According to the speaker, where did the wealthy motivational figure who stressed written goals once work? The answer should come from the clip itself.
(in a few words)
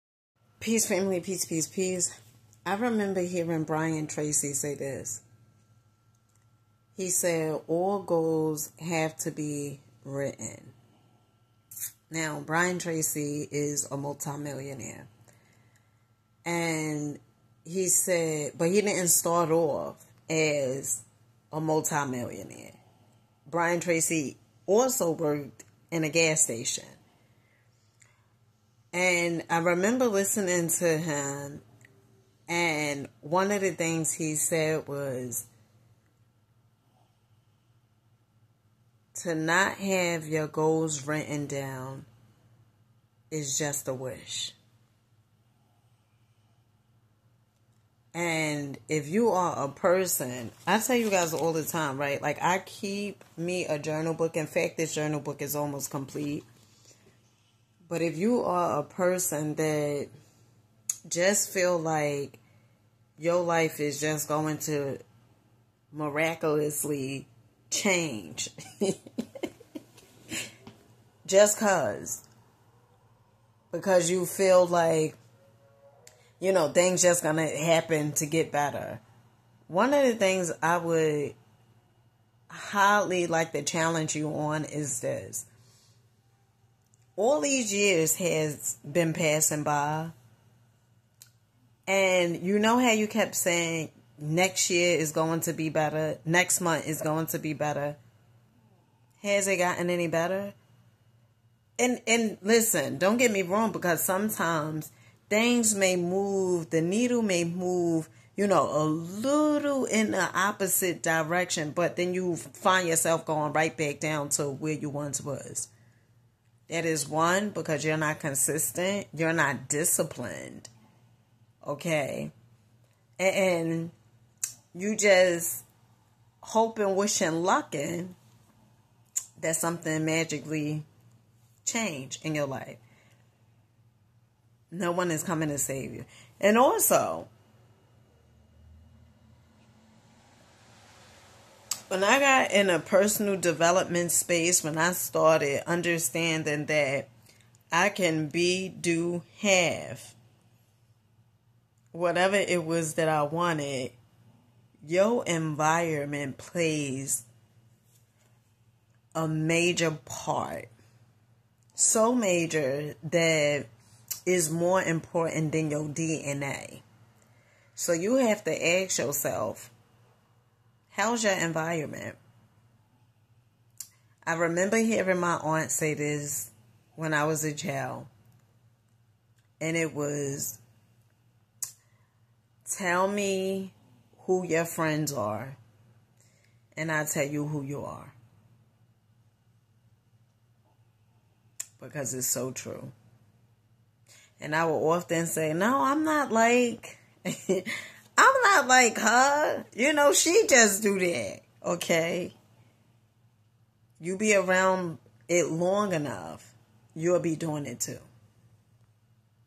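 gas station.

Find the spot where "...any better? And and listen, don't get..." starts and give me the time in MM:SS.
01:39.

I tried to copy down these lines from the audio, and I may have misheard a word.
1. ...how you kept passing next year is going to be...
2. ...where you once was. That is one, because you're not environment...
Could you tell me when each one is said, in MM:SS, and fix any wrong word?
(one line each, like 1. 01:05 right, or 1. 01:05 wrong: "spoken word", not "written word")
1. 01:32 wrong: "saying", not "passing"
2. 01:54 wrong: "consistent", not "environment".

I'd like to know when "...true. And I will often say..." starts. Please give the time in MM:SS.
03:12.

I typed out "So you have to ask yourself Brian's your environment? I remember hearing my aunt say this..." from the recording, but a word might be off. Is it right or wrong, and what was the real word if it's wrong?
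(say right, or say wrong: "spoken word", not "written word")
wrong: "How", not "Brian".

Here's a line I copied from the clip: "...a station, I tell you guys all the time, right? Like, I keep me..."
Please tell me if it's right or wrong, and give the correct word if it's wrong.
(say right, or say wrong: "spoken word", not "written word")
wrong: "person", not "station".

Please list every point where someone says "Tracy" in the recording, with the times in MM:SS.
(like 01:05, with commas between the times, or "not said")
00:04, 00:12, 00:23.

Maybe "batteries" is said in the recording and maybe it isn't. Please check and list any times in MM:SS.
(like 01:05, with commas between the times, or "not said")
not said.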